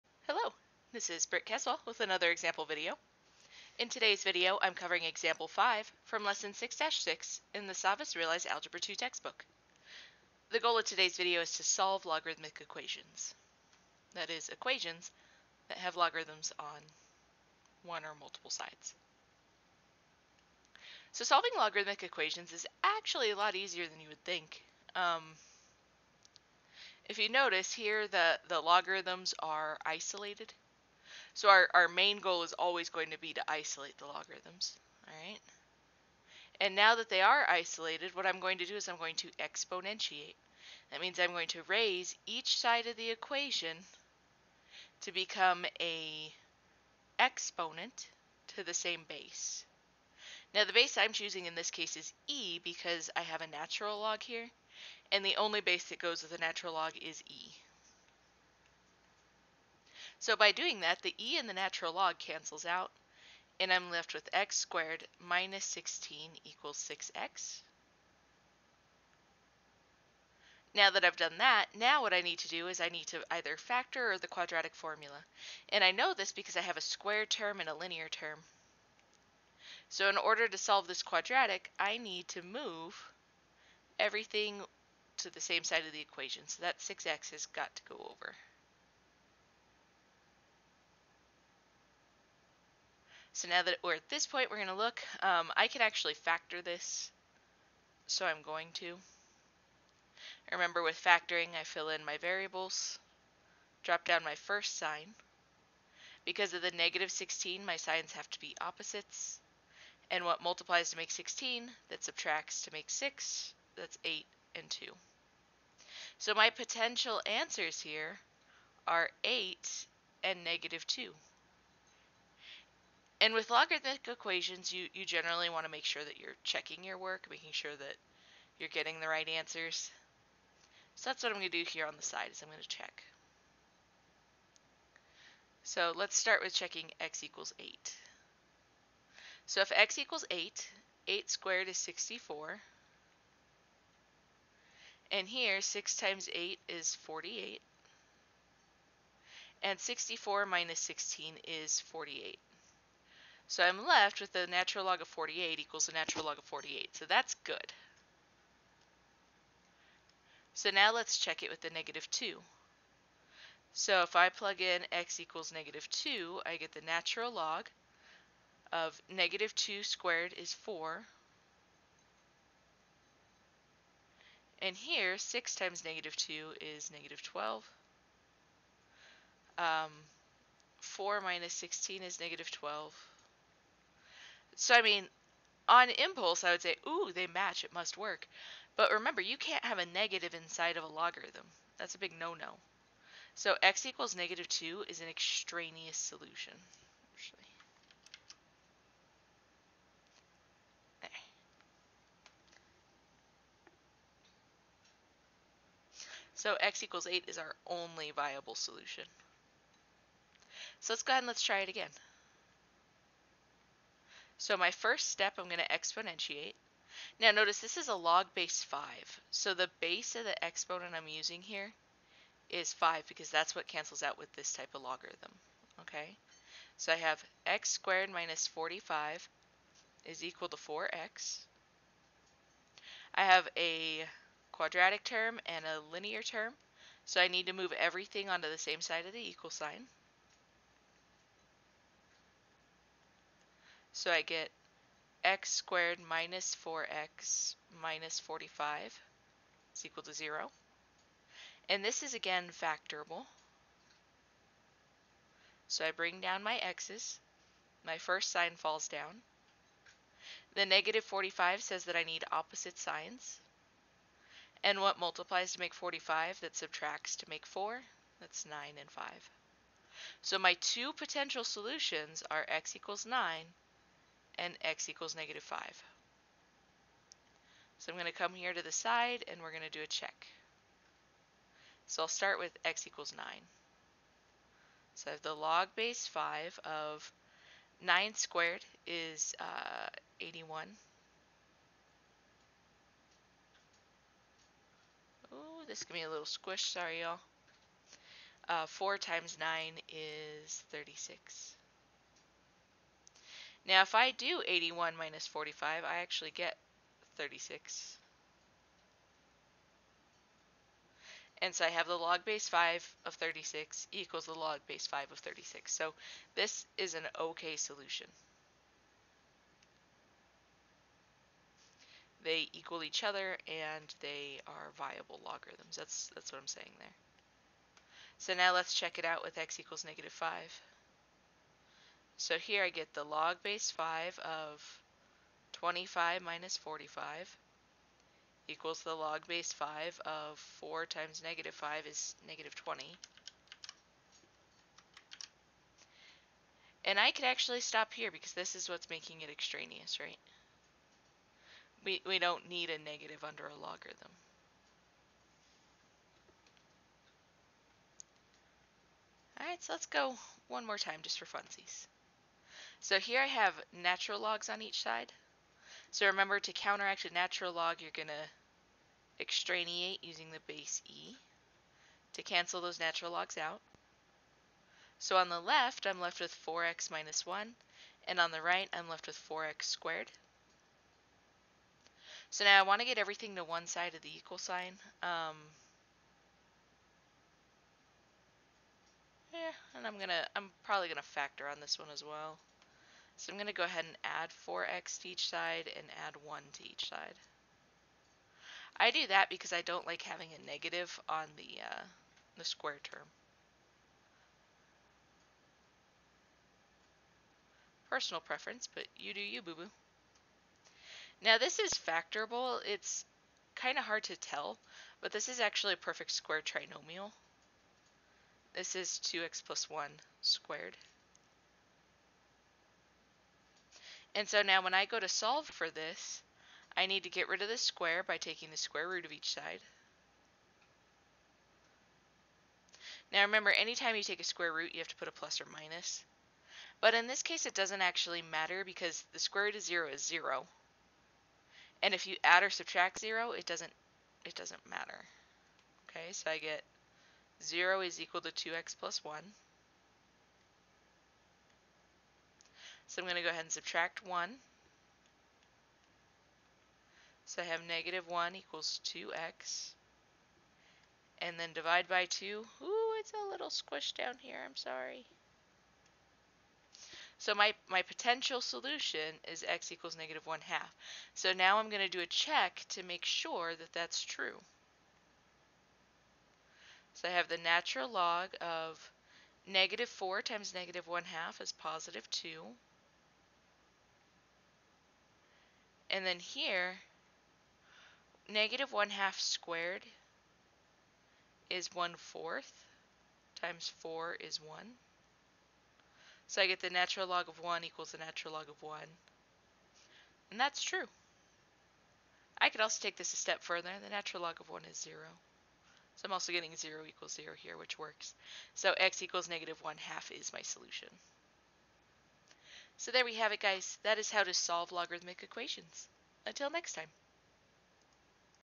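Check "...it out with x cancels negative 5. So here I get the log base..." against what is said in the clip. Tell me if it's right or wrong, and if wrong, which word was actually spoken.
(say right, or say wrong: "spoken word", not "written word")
wrong: "equals", not "cancels".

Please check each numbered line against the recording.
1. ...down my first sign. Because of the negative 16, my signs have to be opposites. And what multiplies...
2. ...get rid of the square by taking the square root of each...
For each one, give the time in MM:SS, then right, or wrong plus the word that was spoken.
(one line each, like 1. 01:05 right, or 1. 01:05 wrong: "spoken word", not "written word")
1. 01:44 right
2. 07:07 right.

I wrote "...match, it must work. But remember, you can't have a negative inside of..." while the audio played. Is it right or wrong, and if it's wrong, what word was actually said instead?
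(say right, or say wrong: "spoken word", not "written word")
right.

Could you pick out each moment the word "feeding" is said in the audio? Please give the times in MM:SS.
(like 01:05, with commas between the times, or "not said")
not said.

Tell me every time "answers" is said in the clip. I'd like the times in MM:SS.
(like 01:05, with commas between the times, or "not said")
01:57, 02:09.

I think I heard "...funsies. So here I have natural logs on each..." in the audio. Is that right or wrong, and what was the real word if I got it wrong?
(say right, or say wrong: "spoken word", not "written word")
right.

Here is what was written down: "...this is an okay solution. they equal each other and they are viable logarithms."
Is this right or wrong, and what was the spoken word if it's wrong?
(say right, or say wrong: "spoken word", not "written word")
right.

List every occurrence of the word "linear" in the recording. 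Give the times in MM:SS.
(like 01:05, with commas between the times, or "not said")
01:17, 03:55.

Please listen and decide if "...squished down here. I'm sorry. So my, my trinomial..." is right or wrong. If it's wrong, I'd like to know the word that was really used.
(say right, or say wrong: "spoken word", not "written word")
wrong: "potential", not "trinomial".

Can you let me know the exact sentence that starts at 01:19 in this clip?
So in order to solve this quadratic, I need to move everything to the same side of the equation.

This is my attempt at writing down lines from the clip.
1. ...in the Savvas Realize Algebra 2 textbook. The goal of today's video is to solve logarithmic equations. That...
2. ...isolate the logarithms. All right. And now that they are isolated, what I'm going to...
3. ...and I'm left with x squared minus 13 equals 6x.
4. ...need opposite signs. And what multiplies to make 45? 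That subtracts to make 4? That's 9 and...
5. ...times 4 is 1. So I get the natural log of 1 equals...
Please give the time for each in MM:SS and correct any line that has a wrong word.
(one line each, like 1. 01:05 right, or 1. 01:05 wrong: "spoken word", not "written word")
1. 00:07 right
2. 00:33 right
3. 01:03 wrong: "16", not "13"
4. 04:22 right
5. 08:13 right.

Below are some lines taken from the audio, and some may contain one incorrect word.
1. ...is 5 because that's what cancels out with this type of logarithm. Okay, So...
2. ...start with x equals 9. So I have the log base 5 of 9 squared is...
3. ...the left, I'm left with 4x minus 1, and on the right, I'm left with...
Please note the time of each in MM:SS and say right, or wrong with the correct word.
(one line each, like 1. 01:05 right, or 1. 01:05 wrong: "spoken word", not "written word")
1. 03:42 right
2. 04:42 right
3. 06:15 right.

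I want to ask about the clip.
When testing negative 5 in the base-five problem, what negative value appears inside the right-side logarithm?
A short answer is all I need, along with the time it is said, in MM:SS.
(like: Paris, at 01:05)
-20, at 05:42.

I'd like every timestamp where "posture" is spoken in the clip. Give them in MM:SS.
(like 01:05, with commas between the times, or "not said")
not said.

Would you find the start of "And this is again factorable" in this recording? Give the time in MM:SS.
04:11.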